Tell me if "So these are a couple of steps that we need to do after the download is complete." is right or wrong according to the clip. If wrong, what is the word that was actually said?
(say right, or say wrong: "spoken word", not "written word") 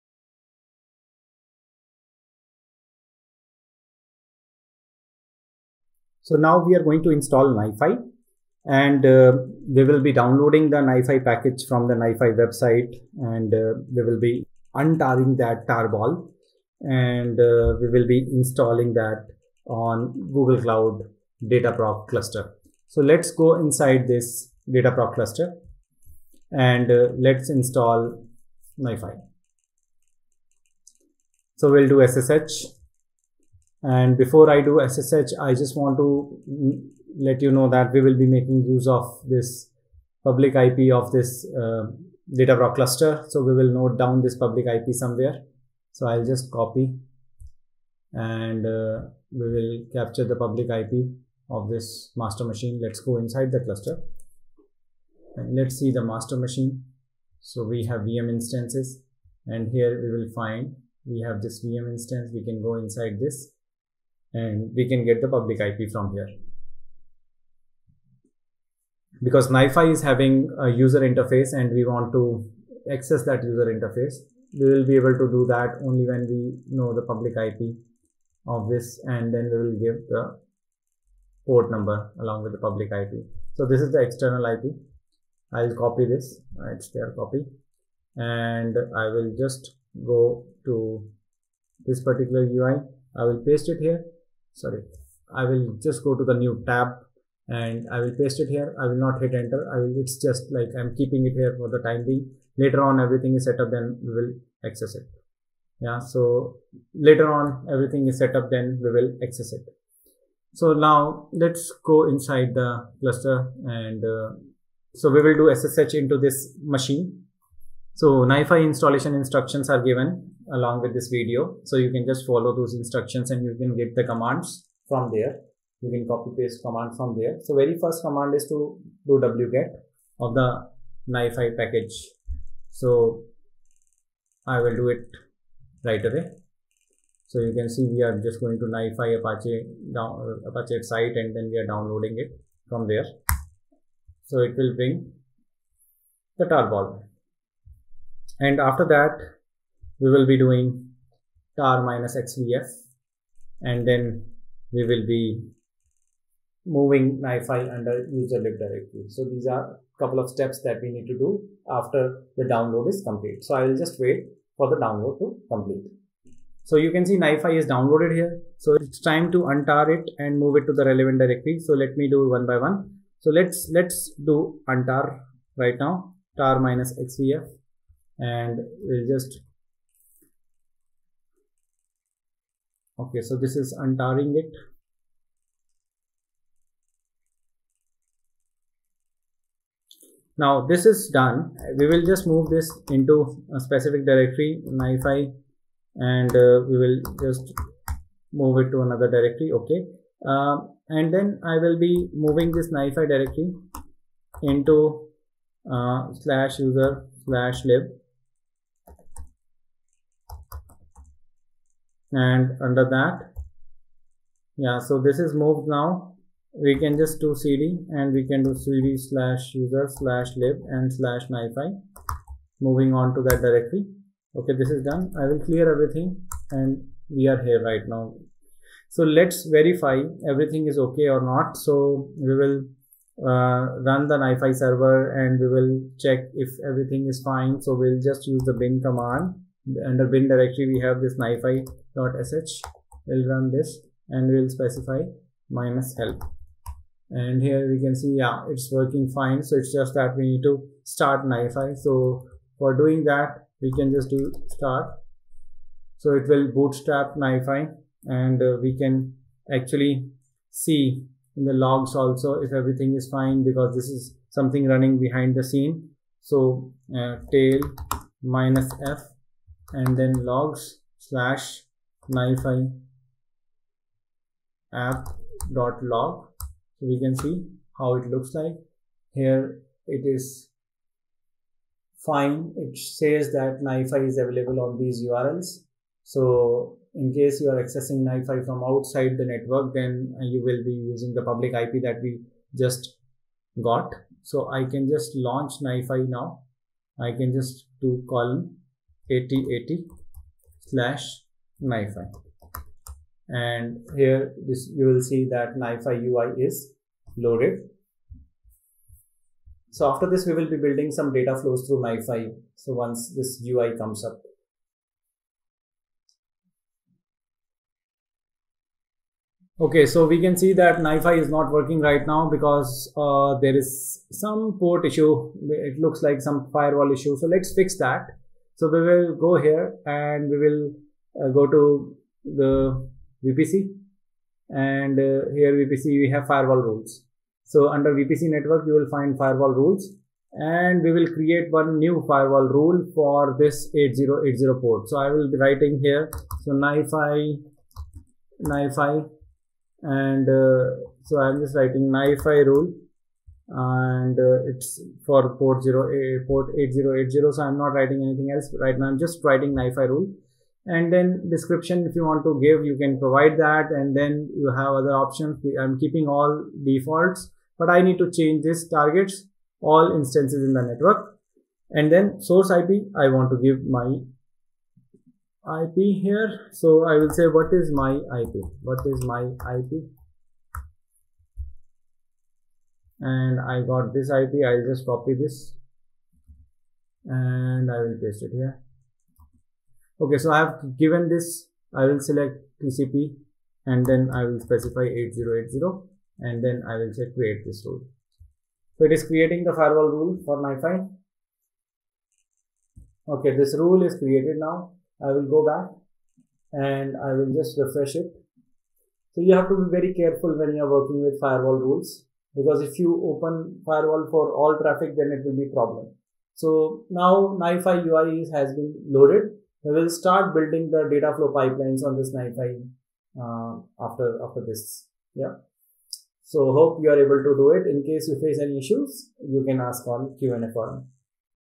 right.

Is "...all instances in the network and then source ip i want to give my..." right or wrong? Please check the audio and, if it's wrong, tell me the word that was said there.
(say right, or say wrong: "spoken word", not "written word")
right.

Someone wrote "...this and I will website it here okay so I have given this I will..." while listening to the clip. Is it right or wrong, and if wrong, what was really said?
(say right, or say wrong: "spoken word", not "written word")
wrong: "paste", not "website".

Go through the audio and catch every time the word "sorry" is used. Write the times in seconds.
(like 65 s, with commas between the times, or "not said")
94 s.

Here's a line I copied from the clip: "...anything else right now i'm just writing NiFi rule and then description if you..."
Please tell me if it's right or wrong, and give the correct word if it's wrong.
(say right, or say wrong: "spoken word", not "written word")
right.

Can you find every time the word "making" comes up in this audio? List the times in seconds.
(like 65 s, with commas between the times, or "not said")
38 s.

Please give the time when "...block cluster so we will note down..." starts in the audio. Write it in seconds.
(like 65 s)
42 s.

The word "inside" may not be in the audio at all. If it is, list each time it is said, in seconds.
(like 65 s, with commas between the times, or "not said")
23 s, 53 s, 62 s, 112 s.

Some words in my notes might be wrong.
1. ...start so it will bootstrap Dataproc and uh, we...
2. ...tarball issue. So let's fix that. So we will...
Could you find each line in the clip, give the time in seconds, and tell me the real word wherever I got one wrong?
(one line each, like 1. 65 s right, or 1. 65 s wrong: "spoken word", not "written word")
1. 254 s wrong: "NiFi", not "Dataproc"
2. 326 s wrong: "firewall", not "tarball".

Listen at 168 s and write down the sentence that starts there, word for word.
So it's time to untar it and move it to the relevant directory.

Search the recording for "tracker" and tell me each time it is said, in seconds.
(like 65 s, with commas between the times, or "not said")
not said.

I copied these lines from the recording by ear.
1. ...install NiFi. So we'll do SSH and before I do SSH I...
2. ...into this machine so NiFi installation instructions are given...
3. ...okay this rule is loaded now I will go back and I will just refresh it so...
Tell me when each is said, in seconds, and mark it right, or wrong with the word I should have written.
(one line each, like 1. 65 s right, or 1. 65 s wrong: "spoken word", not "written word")
1. 27 s right
2. 115 s right
3. 403 s wrong: "created", not "loaded".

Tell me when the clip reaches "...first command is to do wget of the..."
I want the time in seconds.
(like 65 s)
127 s.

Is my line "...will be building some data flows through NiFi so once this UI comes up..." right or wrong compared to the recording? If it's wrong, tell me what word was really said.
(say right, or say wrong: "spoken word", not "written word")
right.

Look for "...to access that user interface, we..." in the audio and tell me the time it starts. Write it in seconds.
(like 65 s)
72 s.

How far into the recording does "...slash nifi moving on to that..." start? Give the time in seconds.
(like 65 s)
220 s.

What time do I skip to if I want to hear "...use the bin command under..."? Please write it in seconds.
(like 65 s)
238 s.